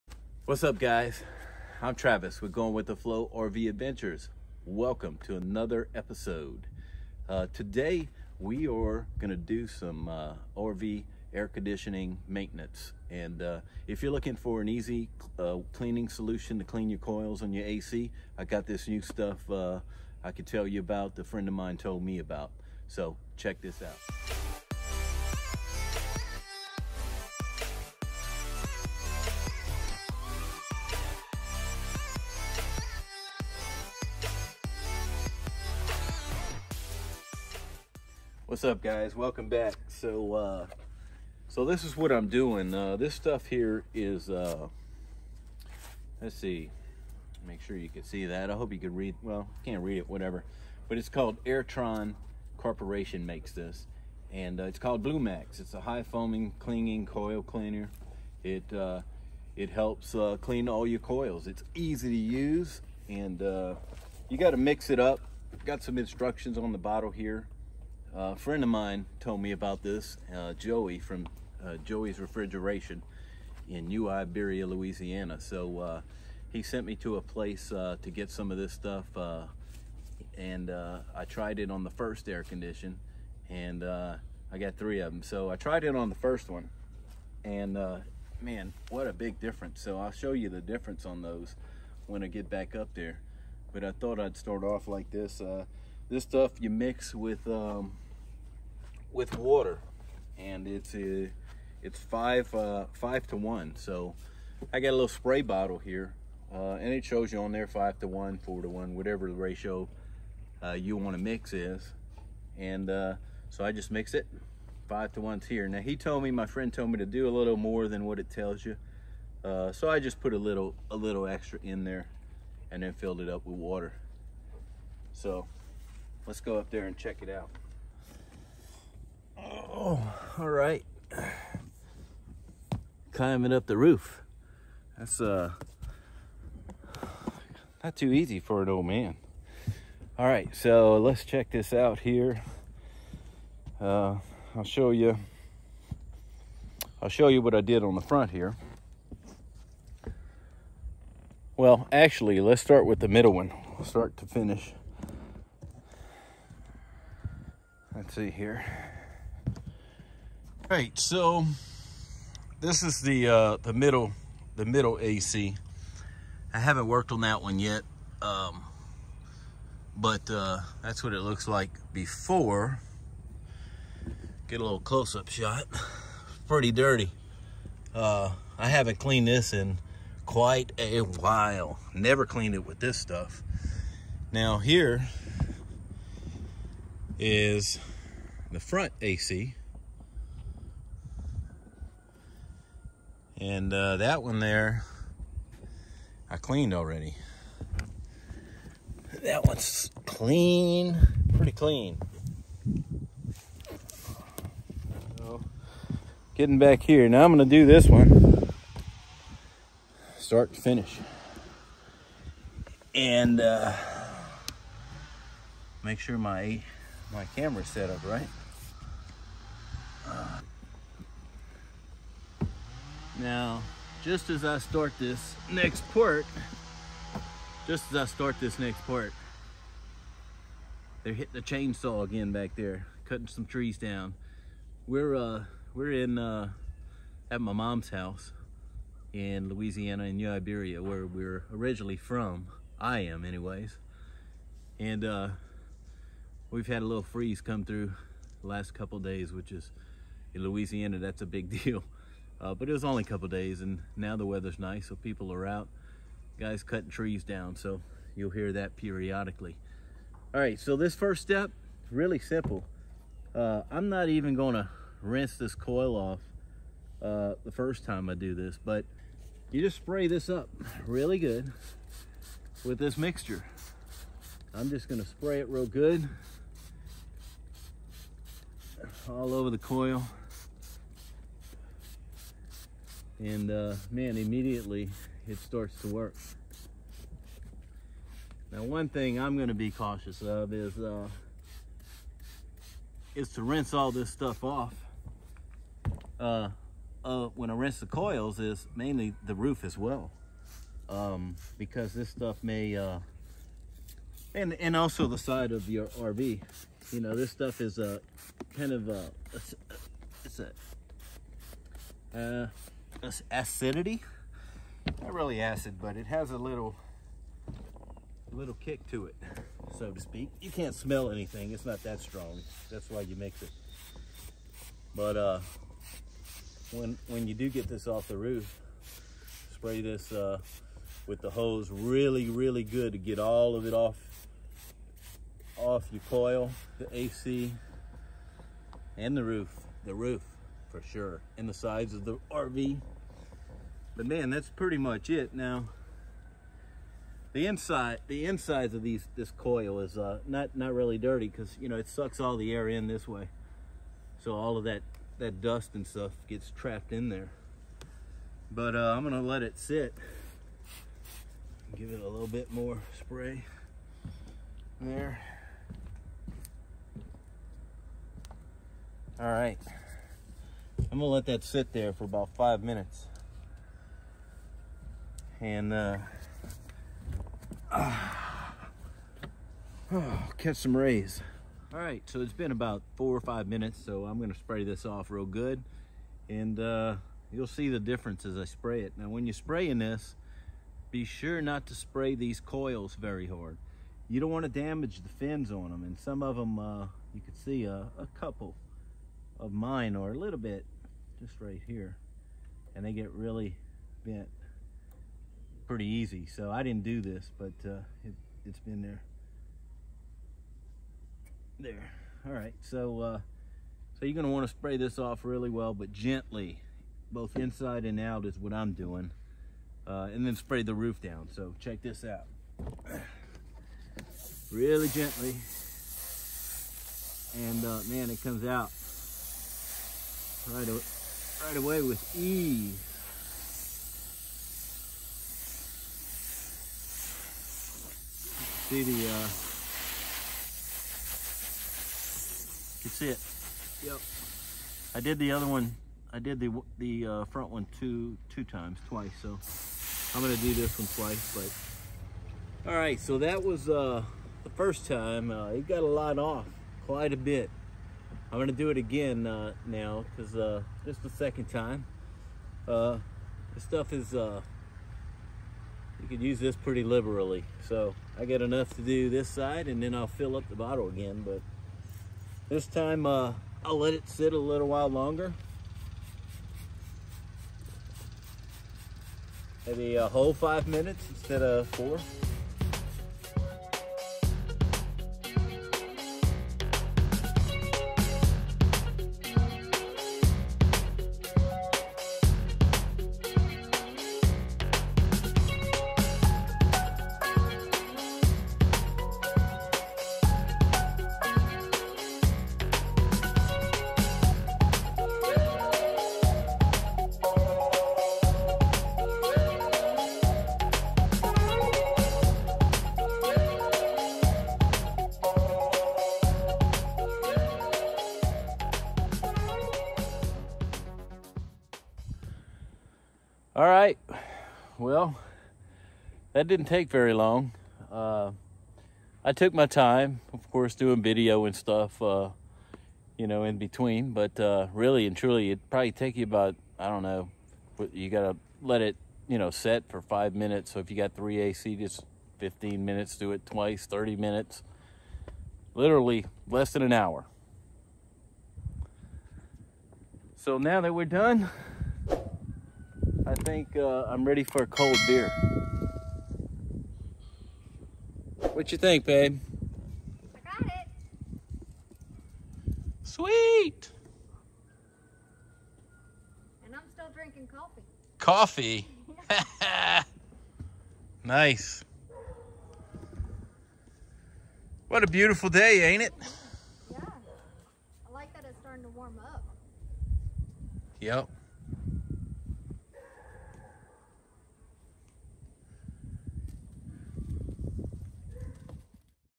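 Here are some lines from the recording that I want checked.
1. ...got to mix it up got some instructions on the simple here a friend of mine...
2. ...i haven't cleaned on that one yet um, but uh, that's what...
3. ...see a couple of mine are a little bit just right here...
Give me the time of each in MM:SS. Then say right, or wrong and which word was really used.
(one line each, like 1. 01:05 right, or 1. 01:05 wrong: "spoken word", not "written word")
1. 01:04 wrong: "bottle", not "simple"
2. 02:46 wrong: "worked", not "cleaned"
3. 06:37 right.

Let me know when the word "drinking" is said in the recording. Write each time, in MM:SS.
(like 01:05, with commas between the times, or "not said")
09:27.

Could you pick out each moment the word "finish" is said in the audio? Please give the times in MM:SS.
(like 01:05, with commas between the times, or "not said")
02:34, 03:30.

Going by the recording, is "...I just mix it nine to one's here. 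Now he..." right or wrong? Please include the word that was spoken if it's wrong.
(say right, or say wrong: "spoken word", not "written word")
wrong: "five", not "nine".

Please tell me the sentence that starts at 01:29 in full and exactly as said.
So I'll show you the difference on those when I get back up there.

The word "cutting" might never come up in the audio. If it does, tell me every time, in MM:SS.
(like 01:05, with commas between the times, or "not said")
03:53, 04:16.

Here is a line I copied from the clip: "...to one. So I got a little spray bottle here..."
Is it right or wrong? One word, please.
right.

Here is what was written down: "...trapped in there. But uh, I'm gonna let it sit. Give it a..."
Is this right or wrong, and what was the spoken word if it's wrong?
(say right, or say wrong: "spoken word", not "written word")
right.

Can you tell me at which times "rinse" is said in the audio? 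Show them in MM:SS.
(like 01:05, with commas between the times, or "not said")
04:25, 04:53, 04:57.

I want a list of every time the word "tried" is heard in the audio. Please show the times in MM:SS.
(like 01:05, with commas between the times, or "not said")
01:21, 01:25.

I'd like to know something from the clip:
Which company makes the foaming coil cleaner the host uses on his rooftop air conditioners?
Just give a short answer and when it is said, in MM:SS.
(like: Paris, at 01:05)
Airtron Corporation, at 00:51.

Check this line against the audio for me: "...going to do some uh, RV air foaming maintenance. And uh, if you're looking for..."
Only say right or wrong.
wrong.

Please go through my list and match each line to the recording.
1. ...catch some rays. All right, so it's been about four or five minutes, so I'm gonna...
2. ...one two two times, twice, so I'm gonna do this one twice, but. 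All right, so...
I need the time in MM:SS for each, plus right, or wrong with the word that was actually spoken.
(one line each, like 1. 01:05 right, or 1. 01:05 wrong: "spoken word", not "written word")
1. 06:20 right
2. 07:27 right.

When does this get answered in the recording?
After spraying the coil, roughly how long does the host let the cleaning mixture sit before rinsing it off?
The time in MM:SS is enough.
06:12.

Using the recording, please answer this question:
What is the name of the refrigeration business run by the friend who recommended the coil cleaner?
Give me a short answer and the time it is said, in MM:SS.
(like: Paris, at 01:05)
Joey's Refrigeration, at 01:11.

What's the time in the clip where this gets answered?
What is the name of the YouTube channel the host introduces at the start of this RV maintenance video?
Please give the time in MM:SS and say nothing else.
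00:02.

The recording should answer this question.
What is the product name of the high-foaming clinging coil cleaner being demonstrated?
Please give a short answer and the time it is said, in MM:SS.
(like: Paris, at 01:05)
Blue Max, at 00:55.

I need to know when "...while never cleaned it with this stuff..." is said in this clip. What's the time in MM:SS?
03:01.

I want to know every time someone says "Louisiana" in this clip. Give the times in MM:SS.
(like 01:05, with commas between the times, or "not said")
01:14, 03:59, 04:10.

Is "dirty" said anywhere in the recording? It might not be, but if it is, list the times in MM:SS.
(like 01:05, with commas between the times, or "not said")
02:56, 05:50.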